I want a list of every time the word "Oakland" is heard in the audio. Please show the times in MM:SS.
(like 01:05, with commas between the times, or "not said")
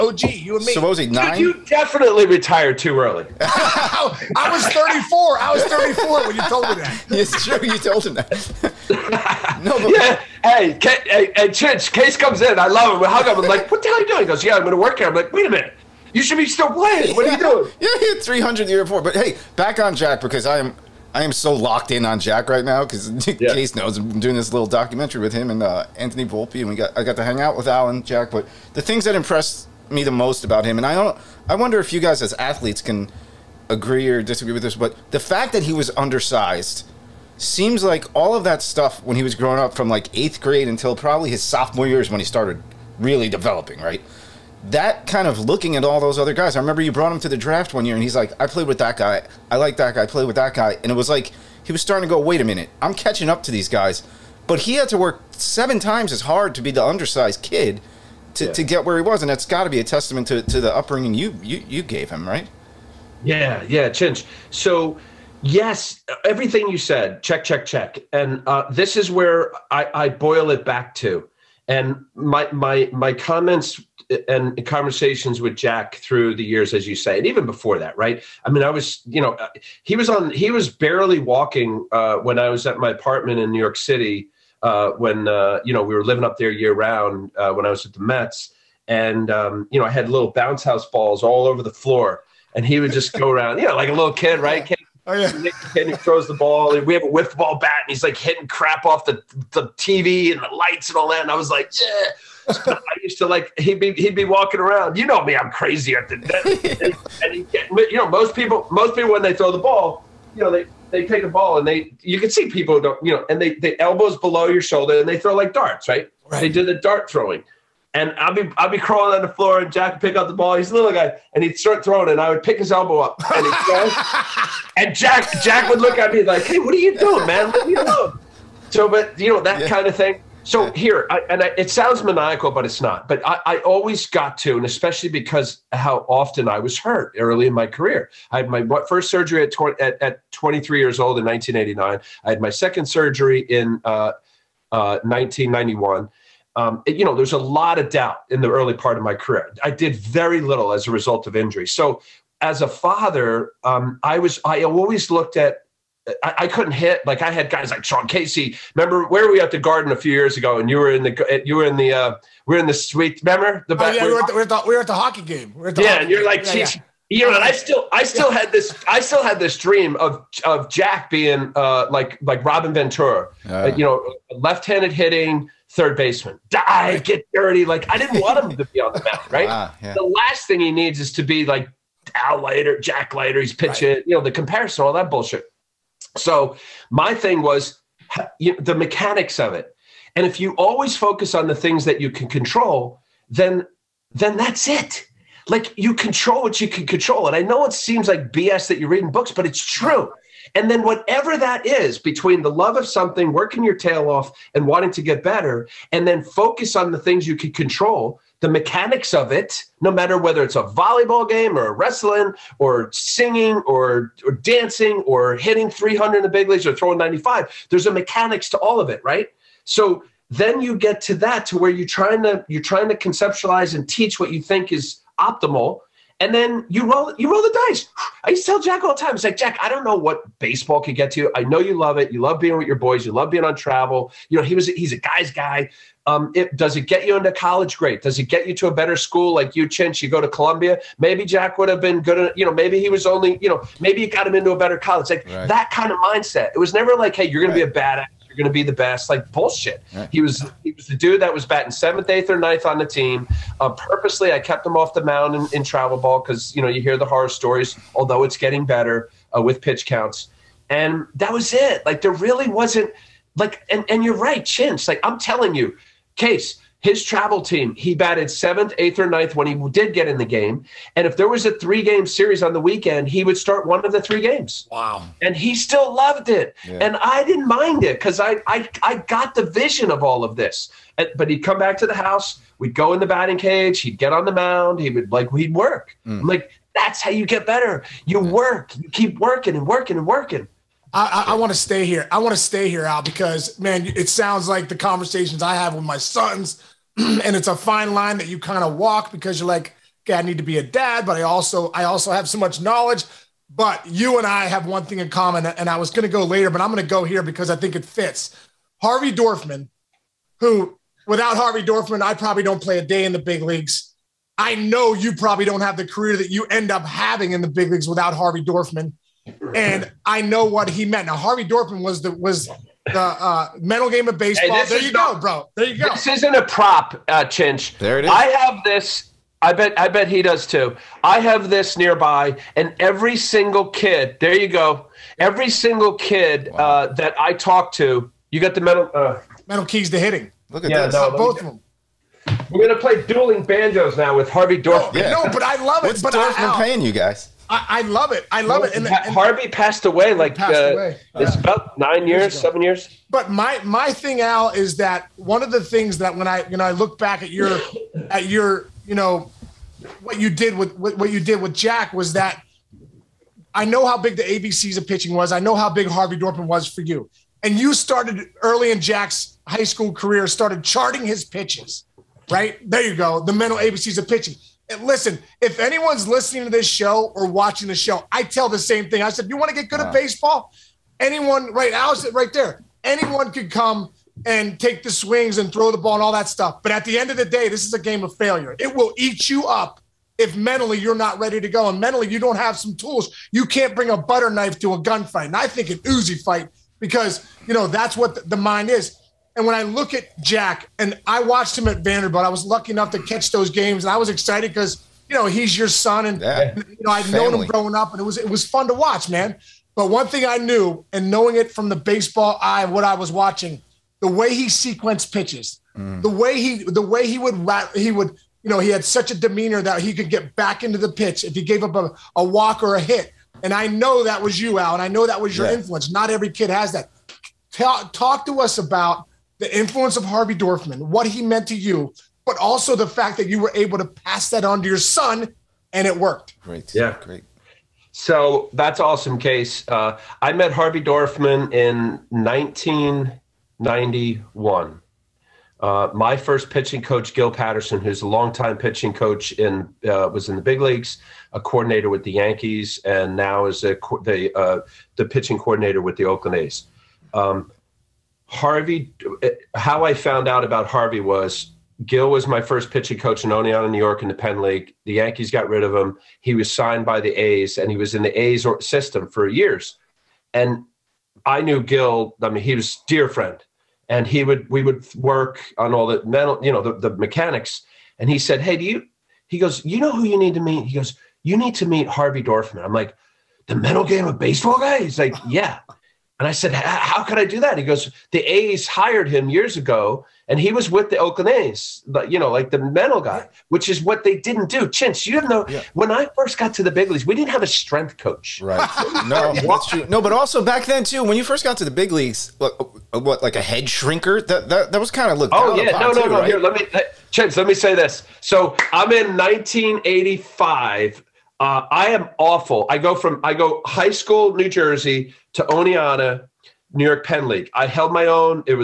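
07:36, 08:10.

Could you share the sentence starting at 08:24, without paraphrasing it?
That that, that was kind of looked Oh, yeah.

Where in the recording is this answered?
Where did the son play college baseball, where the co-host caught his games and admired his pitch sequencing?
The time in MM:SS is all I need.
06:41.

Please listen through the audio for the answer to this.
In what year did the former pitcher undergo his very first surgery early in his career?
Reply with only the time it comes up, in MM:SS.
02:21.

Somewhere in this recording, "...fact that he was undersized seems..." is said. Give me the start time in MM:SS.
00:35.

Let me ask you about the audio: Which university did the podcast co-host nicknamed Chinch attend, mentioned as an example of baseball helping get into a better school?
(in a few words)
Columbia.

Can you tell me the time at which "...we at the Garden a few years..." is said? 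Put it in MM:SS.
02:39.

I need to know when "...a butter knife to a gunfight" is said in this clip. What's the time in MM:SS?
06:33.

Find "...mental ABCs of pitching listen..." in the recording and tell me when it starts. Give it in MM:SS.
06:13.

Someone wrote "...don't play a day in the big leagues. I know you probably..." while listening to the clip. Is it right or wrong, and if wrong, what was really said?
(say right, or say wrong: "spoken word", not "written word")
right.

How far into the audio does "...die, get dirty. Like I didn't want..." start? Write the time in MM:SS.
02:56.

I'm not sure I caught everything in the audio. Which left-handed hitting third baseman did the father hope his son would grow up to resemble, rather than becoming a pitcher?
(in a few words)
Robin Ventura.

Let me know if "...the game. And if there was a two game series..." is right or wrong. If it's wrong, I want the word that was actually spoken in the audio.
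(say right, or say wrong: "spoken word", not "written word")
wrong: "three", not "two".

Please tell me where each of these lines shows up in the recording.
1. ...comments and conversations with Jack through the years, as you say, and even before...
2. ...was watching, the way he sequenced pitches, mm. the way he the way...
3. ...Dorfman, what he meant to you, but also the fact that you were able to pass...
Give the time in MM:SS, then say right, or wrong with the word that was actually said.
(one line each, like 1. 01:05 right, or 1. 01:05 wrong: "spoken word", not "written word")
1. 01:13 right
2. 06:52 right
3. 07:10 right.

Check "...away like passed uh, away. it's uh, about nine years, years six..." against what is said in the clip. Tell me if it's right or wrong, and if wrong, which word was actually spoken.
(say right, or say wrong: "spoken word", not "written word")
wrong: "seven", not "six".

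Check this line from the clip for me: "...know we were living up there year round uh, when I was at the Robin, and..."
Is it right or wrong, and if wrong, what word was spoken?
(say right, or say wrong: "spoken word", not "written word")
wrong: "Mets", not "Robin".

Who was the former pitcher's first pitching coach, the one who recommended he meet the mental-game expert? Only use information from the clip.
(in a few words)
Gil Patterson.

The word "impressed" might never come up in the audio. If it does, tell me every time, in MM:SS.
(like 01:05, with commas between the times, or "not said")
00:29.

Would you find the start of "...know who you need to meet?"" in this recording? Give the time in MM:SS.
07:59.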